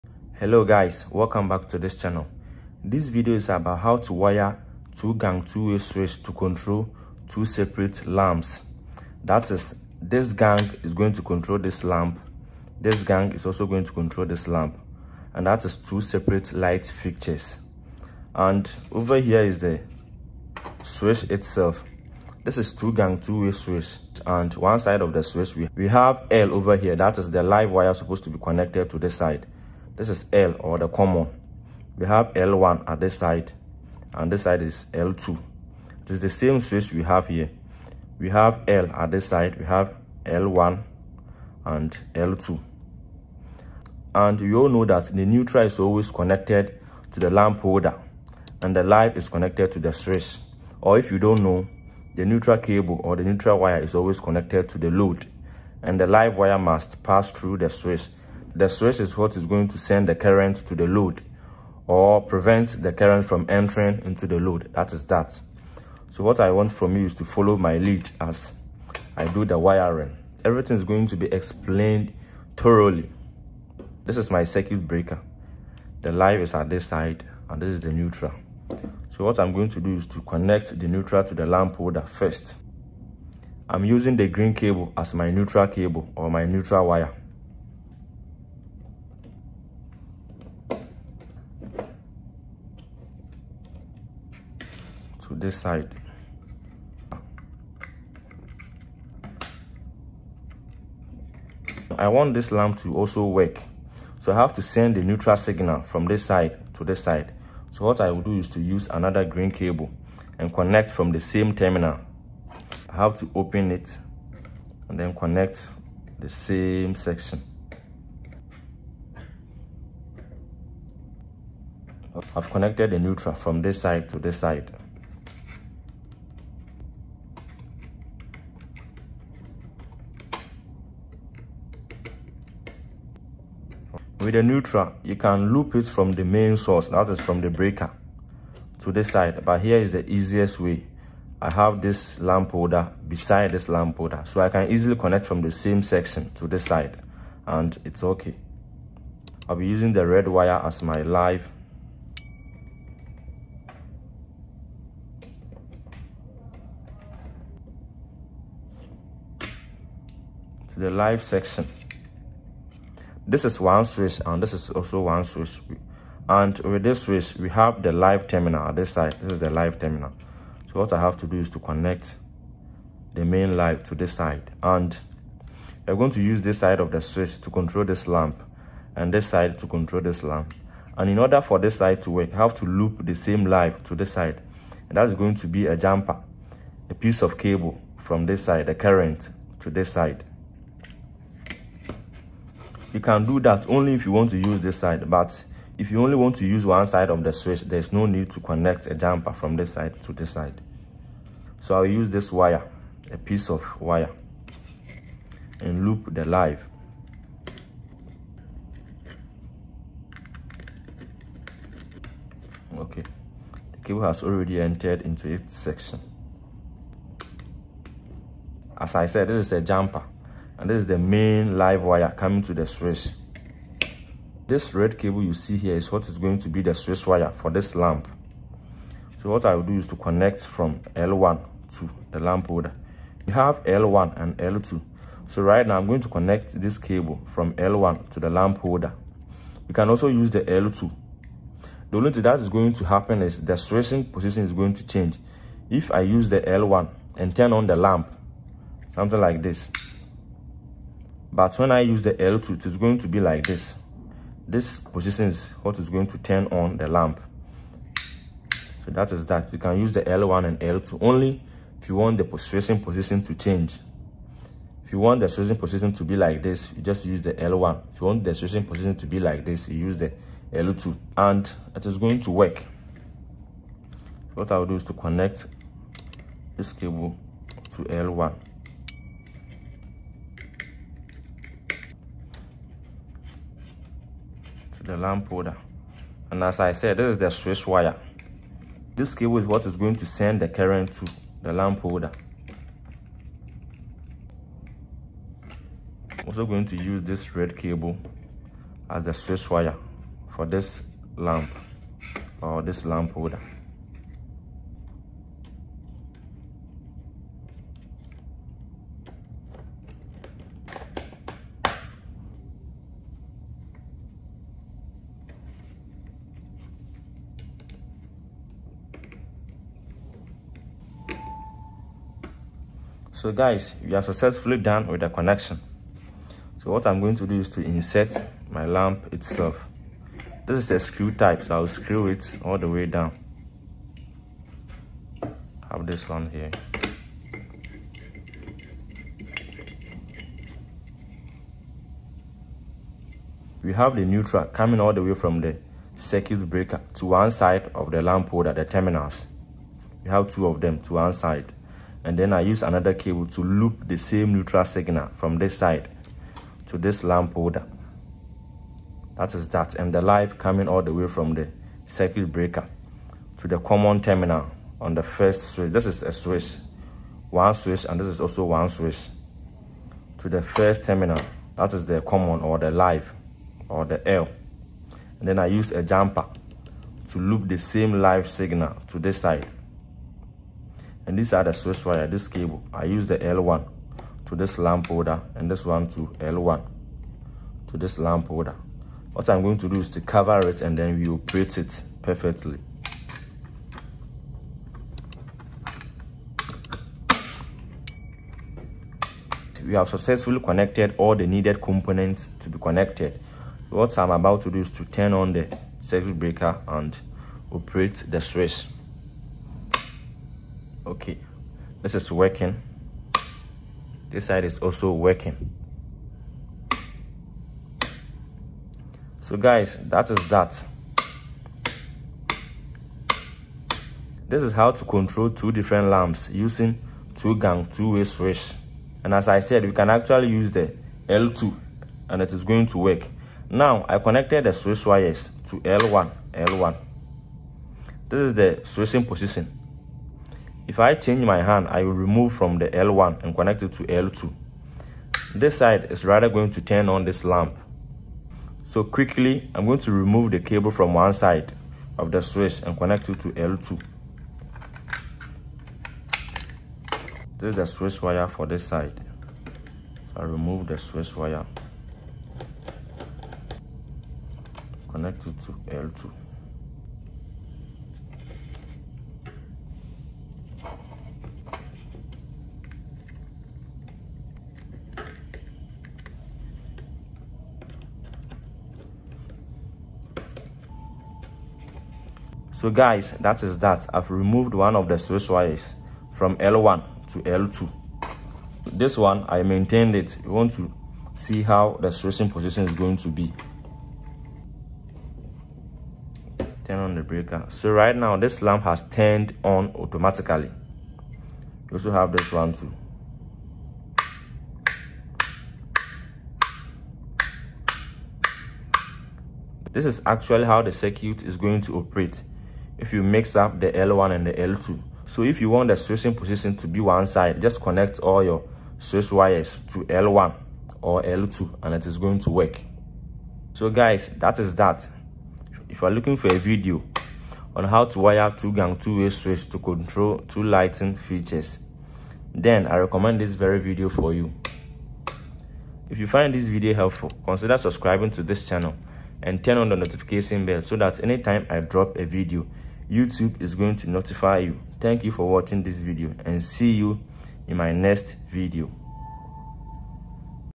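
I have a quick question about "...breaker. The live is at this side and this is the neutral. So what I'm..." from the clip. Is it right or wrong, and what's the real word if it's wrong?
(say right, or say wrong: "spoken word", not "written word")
right.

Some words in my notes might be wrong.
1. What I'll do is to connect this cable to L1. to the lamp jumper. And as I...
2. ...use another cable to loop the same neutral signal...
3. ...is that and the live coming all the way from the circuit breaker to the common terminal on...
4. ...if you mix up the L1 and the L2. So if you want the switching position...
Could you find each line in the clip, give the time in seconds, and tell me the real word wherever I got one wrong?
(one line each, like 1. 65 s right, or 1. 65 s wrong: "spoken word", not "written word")
1. 274 s wrong: "holder", not "jumper"
2. 352 s right
3. 359 s right
4. 512 s right.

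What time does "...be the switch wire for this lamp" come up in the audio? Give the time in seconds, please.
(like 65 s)
226 s.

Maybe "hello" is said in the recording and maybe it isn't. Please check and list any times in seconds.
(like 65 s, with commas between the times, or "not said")
0 s.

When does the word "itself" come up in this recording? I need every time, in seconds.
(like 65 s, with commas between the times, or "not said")
21 s, 329 s.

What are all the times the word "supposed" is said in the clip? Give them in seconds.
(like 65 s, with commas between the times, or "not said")
27 s.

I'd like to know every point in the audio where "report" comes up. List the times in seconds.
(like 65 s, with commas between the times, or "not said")
not said.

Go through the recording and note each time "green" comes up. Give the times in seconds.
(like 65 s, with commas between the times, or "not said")
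84 s, 109 s.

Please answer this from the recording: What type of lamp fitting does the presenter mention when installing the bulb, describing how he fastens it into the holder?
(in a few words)
Screw type.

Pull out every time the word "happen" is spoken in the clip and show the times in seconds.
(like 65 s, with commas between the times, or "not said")
242 s.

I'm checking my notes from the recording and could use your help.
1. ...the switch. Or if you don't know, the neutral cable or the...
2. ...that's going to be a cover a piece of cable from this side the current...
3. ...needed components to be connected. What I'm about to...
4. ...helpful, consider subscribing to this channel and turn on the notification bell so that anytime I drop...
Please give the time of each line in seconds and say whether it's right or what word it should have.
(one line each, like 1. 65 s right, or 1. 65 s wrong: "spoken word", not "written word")
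1. 49 s right
2. 184 s wrong: "jumper", not "cover"
3. 401 s right
4. 536 s right.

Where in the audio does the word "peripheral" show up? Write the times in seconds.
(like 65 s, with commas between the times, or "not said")
not said.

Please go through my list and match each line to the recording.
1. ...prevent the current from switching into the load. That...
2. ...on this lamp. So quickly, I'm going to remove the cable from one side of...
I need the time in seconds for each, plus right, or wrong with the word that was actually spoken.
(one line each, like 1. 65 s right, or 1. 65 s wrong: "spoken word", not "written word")
1. 62 s wrong: "entering", not "switching"
2. 446 s right.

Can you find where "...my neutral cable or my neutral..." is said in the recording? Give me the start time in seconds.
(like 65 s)
85 s.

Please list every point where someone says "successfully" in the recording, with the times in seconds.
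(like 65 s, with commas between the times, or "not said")
324 s, 399 s.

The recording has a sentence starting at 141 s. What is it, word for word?
I have this lamp holder beside this lamp holder.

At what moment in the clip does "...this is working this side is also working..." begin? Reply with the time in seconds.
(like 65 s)
411 s.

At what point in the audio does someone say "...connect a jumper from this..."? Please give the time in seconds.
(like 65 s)
198 s.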